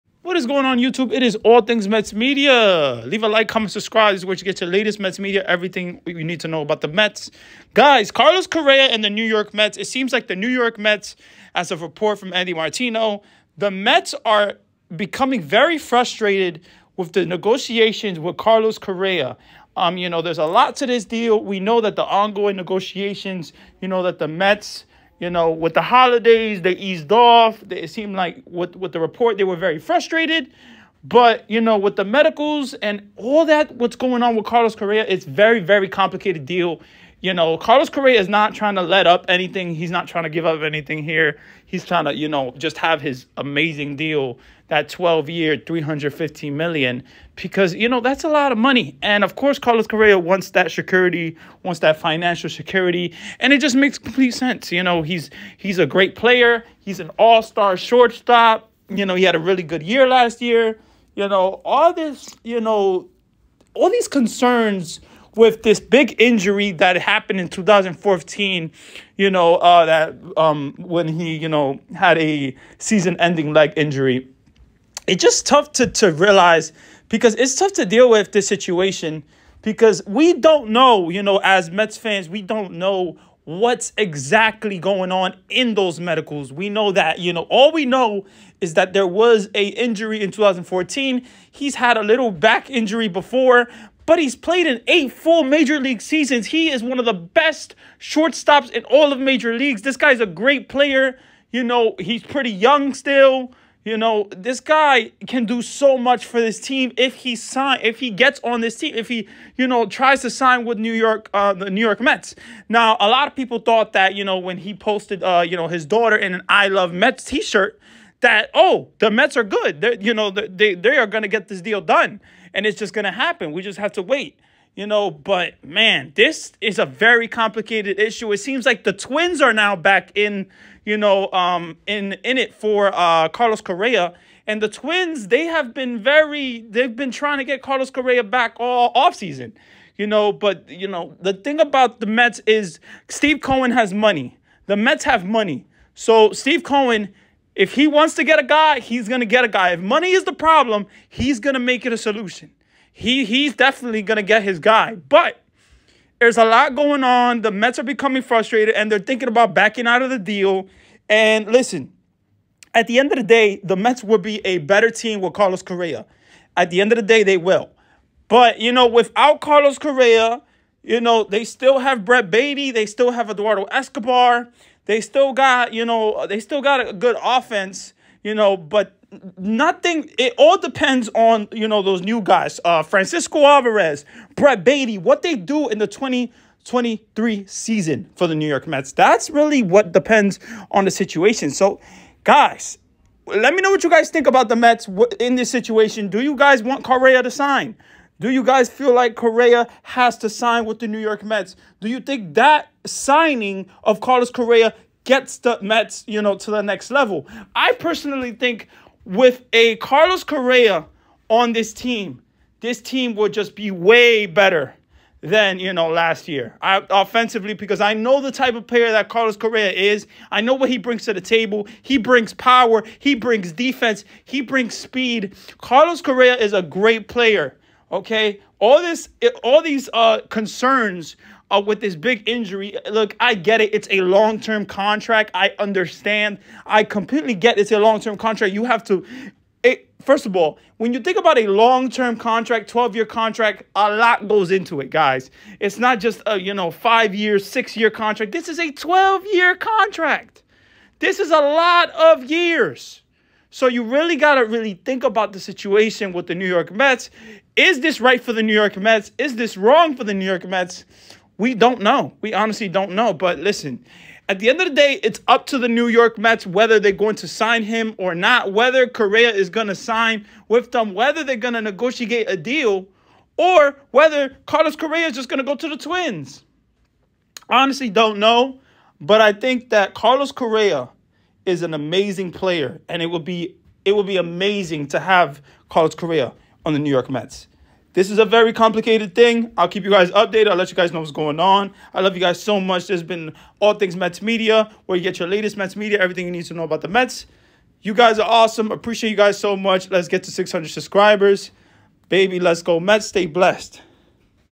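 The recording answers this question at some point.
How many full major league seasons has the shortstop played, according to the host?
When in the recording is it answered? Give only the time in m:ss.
1:34.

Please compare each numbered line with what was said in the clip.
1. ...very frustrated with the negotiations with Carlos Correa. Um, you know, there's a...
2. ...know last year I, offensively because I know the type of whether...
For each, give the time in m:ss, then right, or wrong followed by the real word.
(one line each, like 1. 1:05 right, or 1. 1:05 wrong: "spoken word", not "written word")
1. 0:15 right
2. 3:35 wrong: "player", not "whether".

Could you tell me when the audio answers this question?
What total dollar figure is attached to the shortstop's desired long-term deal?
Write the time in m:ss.
0:45.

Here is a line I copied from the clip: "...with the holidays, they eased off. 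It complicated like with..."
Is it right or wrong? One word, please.
wrong.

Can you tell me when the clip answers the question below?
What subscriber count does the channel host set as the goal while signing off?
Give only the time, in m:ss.
5:00.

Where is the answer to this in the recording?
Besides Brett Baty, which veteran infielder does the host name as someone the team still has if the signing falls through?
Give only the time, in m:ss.
2:53.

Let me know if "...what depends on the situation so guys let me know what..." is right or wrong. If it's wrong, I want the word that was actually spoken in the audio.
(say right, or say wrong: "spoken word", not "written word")
right.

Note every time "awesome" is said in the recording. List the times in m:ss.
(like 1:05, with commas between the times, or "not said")
4:58.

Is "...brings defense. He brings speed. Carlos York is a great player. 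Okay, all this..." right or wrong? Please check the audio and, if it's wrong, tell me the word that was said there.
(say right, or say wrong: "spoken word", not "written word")
wrong: "Correa", not "York".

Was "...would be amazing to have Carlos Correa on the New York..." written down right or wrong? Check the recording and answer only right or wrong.
right.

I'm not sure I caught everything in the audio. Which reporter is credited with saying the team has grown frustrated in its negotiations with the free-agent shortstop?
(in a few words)
Andy Martino.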